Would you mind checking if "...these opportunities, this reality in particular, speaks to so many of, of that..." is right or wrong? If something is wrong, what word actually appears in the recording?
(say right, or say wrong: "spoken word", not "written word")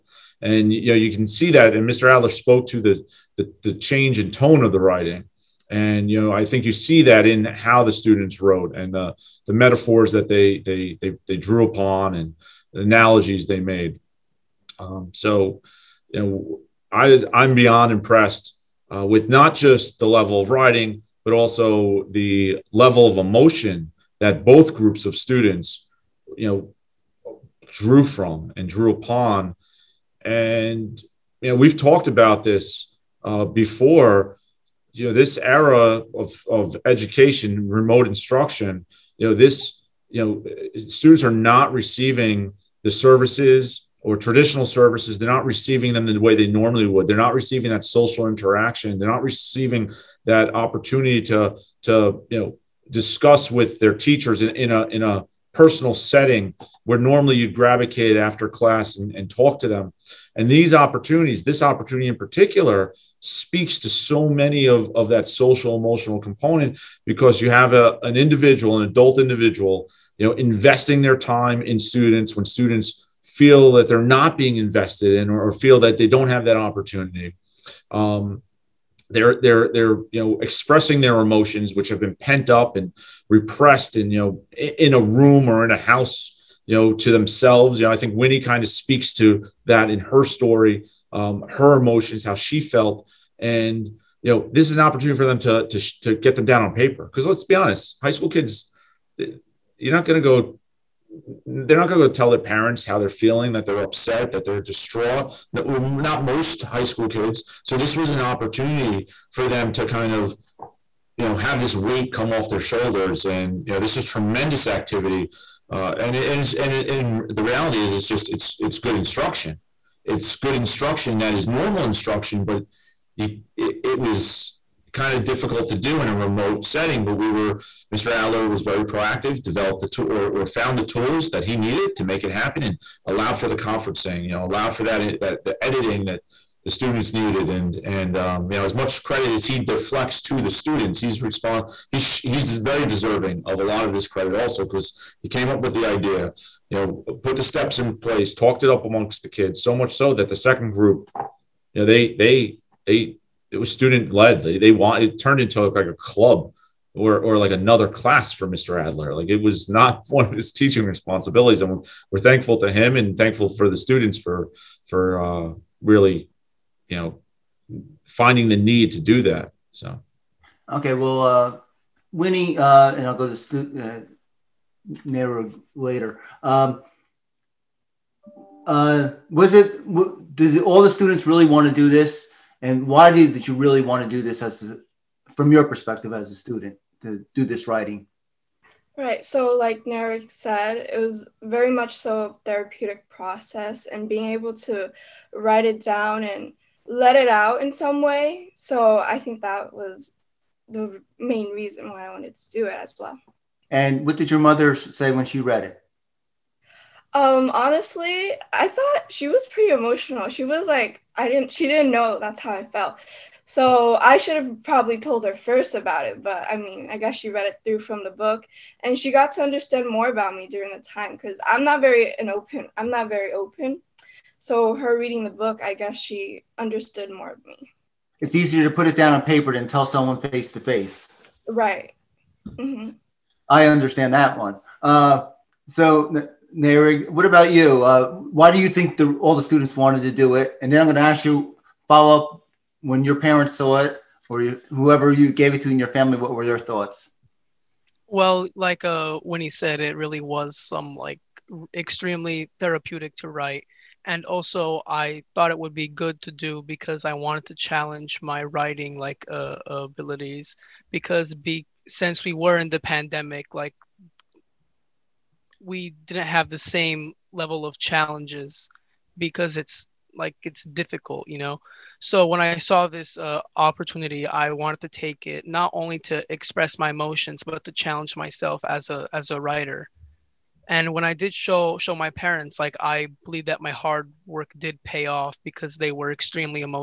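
wrong: "opportunity", not "reality".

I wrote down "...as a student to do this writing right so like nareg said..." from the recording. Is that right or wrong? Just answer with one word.
right.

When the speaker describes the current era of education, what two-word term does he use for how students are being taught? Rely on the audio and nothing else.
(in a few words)
remote instruction.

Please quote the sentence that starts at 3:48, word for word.
It's easier to put it down on paper than tell someone face to face.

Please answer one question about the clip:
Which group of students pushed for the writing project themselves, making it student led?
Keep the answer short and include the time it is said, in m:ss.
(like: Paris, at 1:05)
the second group, at 2:30.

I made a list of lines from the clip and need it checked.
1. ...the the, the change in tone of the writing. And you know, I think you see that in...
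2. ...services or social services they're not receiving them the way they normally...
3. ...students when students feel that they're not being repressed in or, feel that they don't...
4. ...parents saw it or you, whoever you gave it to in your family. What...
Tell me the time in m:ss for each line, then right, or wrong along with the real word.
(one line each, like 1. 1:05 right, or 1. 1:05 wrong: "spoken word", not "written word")
1. 0:02 right
2. 0:42 wrong: "traditional", not "social"
3. 1:11 wrong: "invested", not "repressed"
4. 4:03 right.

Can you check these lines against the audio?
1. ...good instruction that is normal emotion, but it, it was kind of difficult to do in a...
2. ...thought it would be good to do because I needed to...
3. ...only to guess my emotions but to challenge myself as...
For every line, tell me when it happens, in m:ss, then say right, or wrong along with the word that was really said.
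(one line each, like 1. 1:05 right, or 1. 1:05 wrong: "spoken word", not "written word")
1. 2:00 wrong: "instruction", not "emotion"
2. 4:15 wrong: "wanted", not "needed"
3. 4:35 wrong: "express", not "guess".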